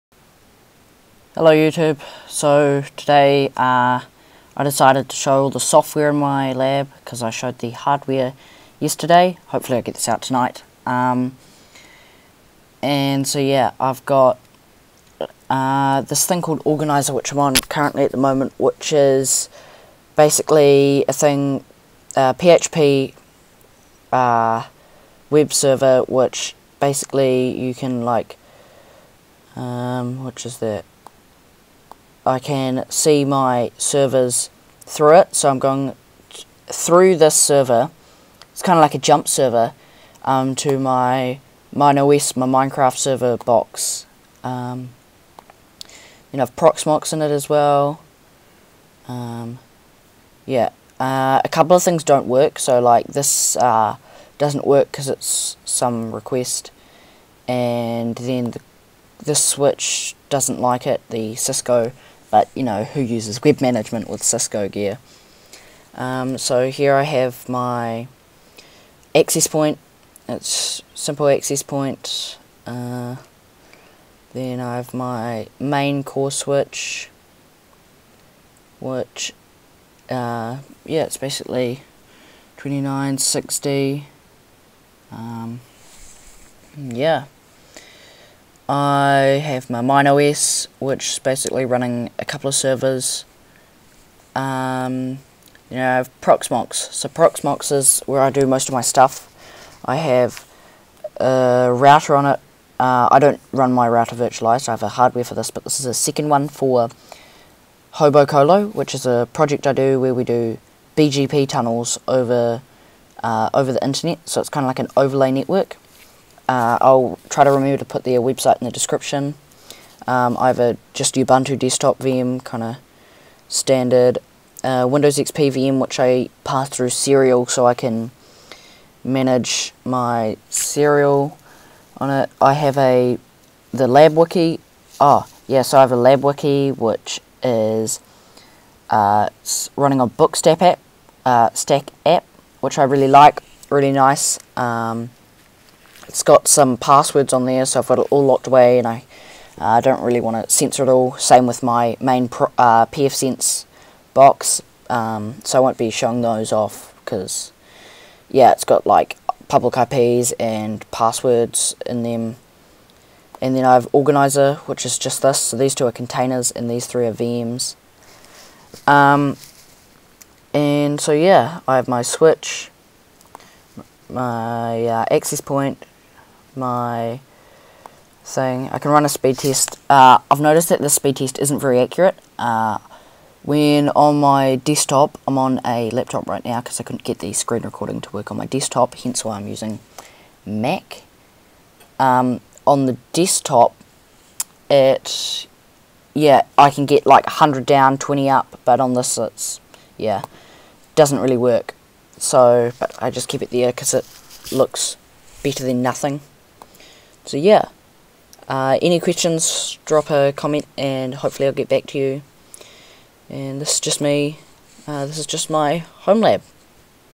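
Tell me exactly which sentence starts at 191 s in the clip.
Um, on the desktop, it, yeah, I can get like 100 down, 20 up, but on this it's, yeah, doesn't really work.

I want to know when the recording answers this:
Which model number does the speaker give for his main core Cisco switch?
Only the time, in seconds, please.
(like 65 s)
82 s.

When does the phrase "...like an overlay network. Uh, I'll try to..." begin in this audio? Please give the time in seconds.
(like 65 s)
114 s.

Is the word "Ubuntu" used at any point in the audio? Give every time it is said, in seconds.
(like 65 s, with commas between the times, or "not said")
121 s.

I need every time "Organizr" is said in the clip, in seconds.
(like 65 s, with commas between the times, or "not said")
16 s, 163 s.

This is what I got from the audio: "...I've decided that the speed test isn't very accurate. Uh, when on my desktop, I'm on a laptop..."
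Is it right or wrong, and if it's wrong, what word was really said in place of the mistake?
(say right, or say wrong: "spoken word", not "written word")
wrong: "noticed", not "decided".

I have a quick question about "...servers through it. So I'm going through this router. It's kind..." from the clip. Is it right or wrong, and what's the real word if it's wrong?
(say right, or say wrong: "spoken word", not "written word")
wrong: "server", not "router".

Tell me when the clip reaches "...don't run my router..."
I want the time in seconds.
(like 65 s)
103 s.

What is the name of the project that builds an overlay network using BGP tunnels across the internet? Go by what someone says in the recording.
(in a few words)
Hobocolo.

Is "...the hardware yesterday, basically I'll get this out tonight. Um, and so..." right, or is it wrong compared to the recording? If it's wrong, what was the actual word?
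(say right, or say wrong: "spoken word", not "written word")
wrong: "hopefully", not "basically".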